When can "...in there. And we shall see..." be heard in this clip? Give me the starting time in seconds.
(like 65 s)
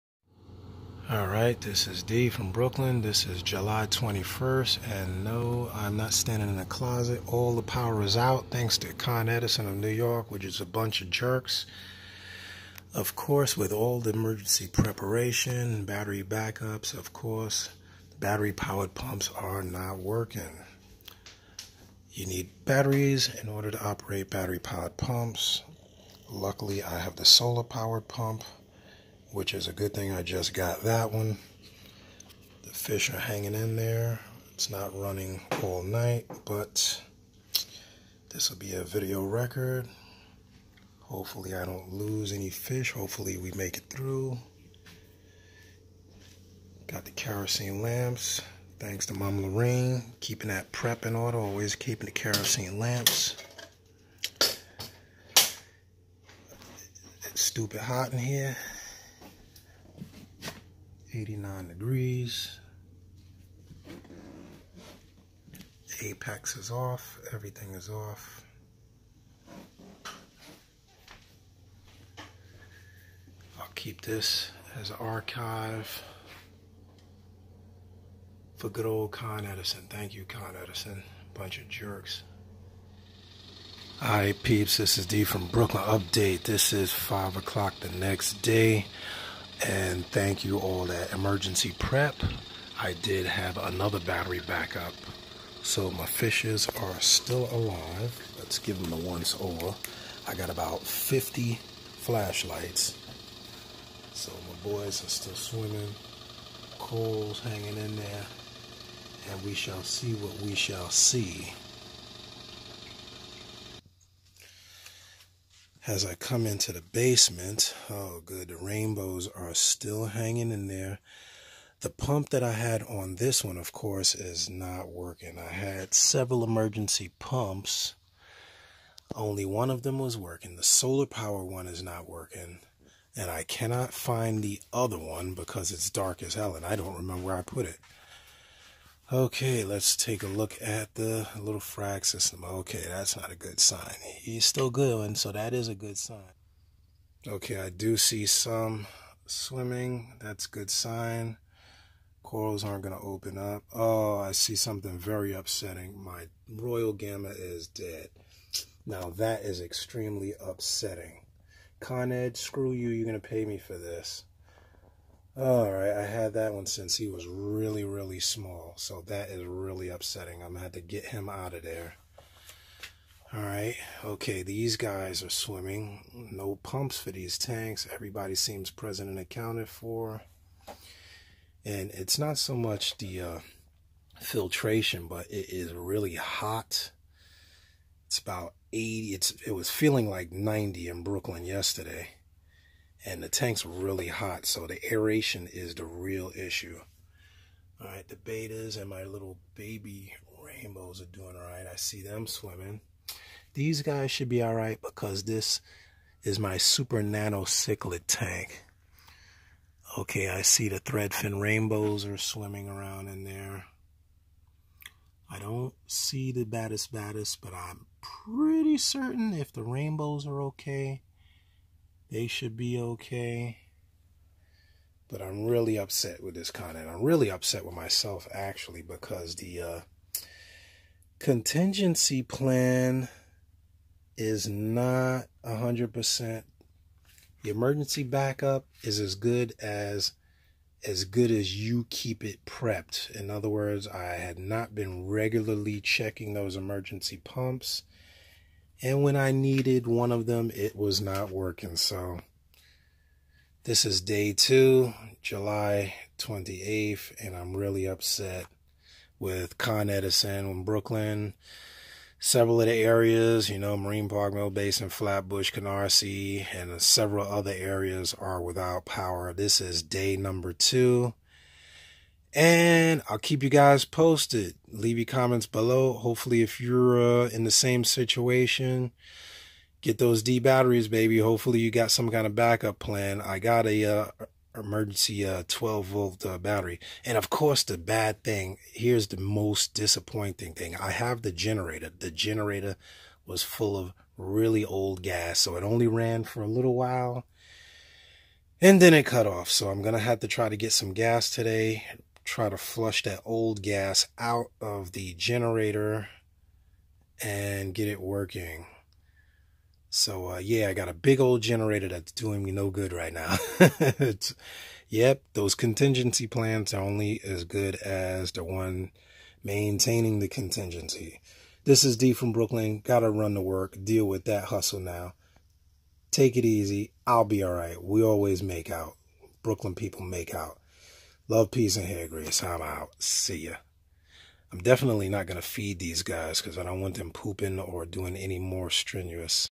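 107 s.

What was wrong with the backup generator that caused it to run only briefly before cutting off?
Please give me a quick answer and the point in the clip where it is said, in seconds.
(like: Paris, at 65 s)
really old gas, at 294 s.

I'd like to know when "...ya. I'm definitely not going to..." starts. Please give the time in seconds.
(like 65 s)
333 s.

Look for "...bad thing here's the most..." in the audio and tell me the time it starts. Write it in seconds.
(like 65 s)
287 s.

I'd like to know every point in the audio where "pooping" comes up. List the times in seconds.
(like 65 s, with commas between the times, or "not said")
337 s.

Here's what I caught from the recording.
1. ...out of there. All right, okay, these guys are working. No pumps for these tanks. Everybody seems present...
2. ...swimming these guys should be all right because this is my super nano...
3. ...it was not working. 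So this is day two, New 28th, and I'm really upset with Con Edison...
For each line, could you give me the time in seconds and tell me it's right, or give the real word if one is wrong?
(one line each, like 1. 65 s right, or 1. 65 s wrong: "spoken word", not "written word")
1. 171 s wrong: "swimming", not "working"
2. 202 s right
3. 250 s wrong: "July", not "New".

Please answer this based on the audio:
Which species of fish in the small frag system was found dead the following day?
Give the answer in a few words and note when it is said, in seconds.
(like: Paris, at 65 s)
royal gramma, at 156 s.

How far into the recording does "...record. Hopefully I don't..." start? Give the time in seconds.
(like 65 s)
39 s.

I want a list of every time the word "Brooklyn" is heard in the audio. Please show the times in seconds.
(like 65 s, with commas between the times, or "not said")
2 s, 85 s, 191 s, 260 s, 322 s, 329 s.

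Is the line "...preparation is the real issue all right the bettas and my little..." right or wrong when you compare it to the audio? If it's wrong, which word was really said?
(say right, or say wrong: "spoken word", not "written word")
wrong: "aeration", not "preparation".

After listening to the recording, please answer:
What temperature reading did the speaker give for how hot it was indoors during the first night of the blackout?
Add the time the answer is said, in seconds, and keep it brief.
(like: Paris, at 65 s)
89 degrees, at 61 s.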